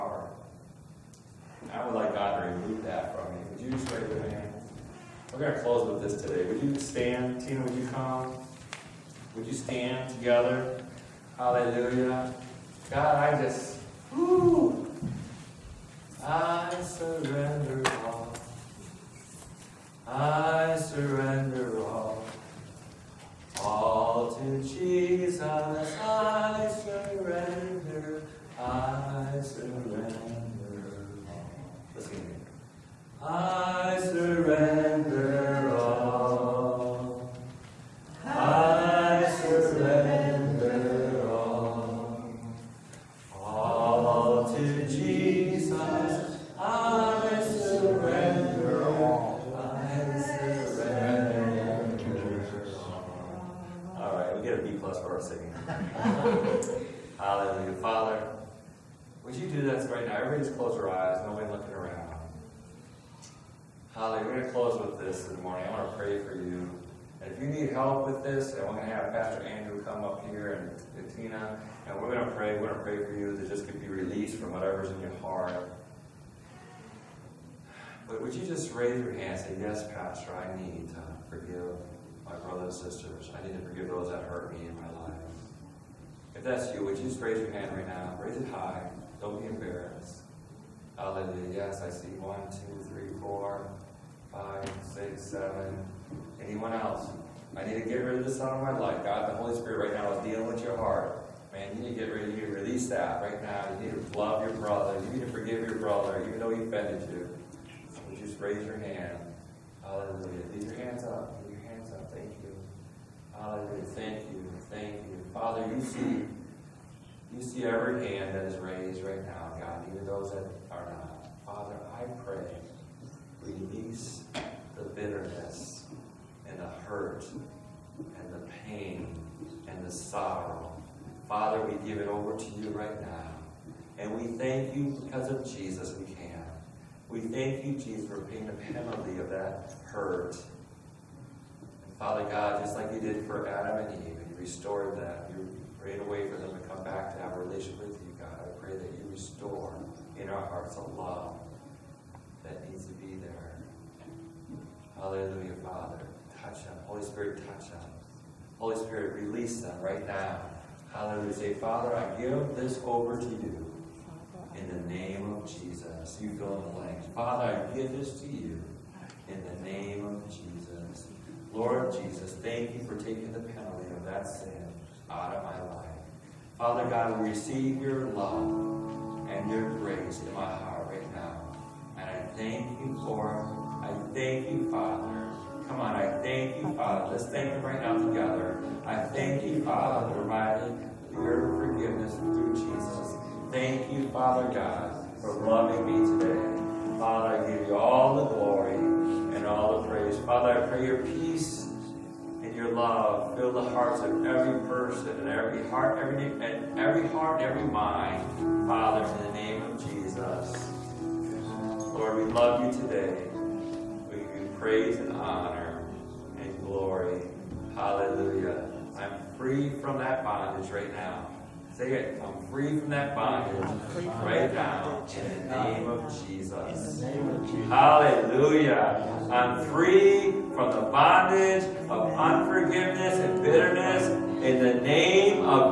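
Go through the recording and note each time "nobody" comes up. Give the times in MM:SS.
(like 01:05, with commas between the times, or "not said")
01:01.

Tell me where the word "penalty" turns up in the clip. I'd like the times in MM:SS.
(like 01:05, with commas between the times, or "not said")
02:18, 02:53.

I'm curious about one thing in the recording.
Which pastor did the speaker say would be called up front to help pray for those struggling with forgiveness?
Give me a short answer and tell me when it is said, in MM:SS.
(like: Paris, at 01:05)
Andrew, at 01:09.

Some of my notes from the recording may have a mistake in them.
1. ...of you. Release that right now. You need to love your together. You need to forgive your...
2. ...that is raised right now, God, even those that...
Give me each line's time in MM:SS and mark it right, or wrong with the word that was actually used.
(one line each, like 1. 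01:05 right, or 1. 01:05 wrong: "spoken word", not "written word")
1. 01:42 wrong: "brother", not "together"
2. 01:58 right.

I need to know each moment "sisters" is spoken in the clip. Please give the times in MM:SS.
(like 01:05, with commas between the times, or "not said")
01:22.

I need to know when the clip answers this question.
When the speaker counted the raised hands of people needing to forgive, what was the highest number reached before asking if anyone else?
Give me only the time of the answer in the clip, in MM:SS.
01:35.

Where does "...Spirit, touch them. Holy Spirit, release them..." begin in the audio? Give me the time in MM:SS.
02:37.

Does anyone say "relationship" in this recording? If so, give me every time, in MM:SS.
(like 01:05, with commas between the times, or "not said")
02:27.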